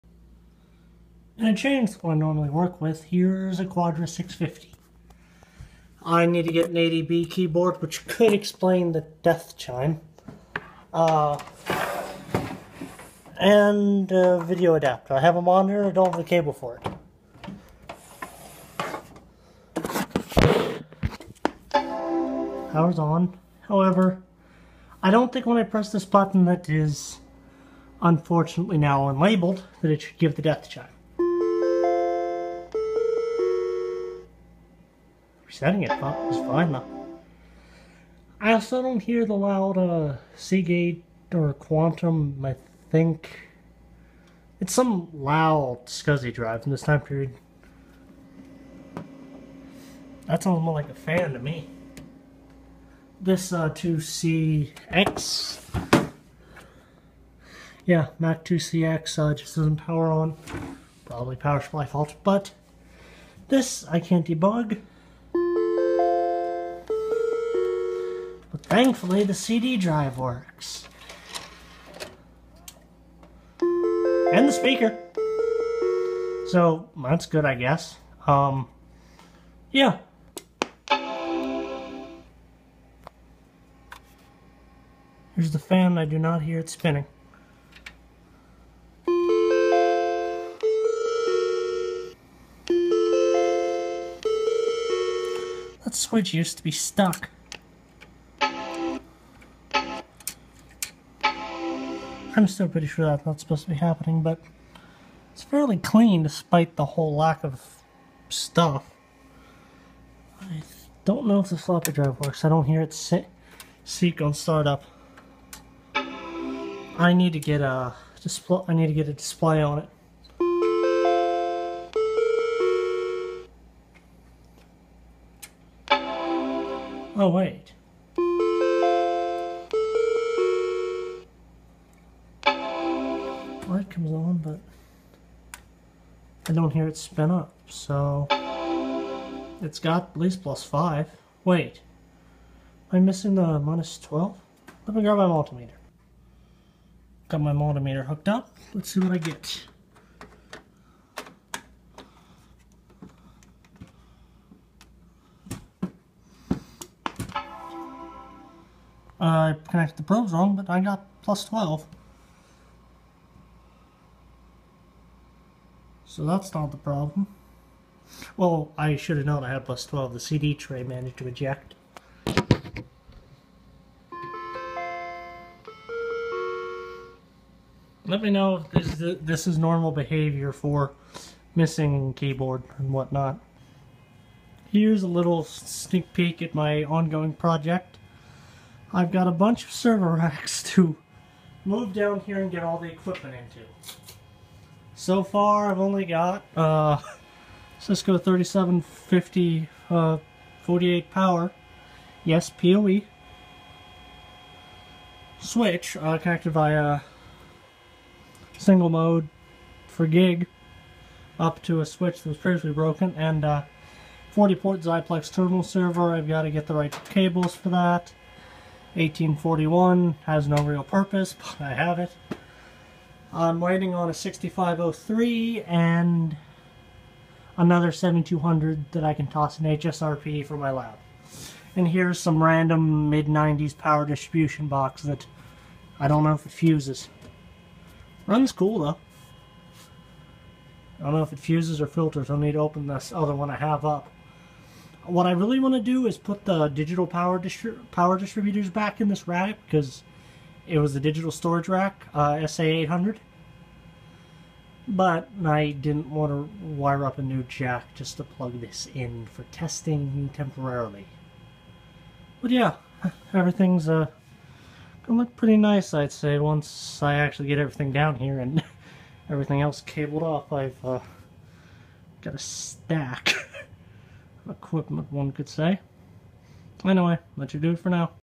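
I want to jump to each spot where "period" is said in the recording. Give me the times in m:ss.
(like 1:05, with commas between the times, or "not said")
0:47.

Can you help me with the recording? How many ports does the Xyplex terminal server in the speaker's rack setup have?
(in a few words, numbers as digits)
40.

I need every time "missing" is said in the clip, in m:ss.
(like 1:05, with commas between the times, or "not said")
2:22, 3:01.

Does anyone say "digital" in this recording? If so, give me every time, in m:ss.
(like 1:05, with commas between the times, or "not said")
4:06, 4:11.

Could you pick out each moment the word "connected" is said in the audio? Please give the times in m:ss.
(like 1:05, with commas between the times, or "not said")
2:39, 3:26.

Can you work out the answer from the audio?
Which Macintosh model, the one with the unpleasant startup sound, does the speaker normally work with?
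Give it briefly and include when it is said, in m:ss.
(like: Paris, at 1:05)
Quadra 650, at 0:03.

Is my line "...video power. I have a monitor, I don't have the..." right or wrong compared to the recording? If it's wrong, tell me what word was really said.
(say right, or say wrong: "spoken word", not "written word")
wrong: "adapter", not "power".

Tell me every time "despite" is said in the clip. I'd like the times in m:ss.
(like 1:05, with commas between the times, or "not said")
1:46.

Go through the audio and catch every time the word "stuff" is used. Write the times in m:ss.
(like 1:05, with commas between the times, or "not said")
1:48.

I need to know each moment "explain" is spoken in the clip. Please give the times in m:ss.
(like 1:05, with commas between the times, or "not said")
0:08.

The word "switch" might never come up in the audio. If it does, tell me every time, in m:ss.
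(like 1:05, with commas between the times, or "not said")
1:35, 3:25, 3:31.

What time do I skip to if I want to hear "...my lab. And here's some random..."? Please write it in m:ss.
3:50.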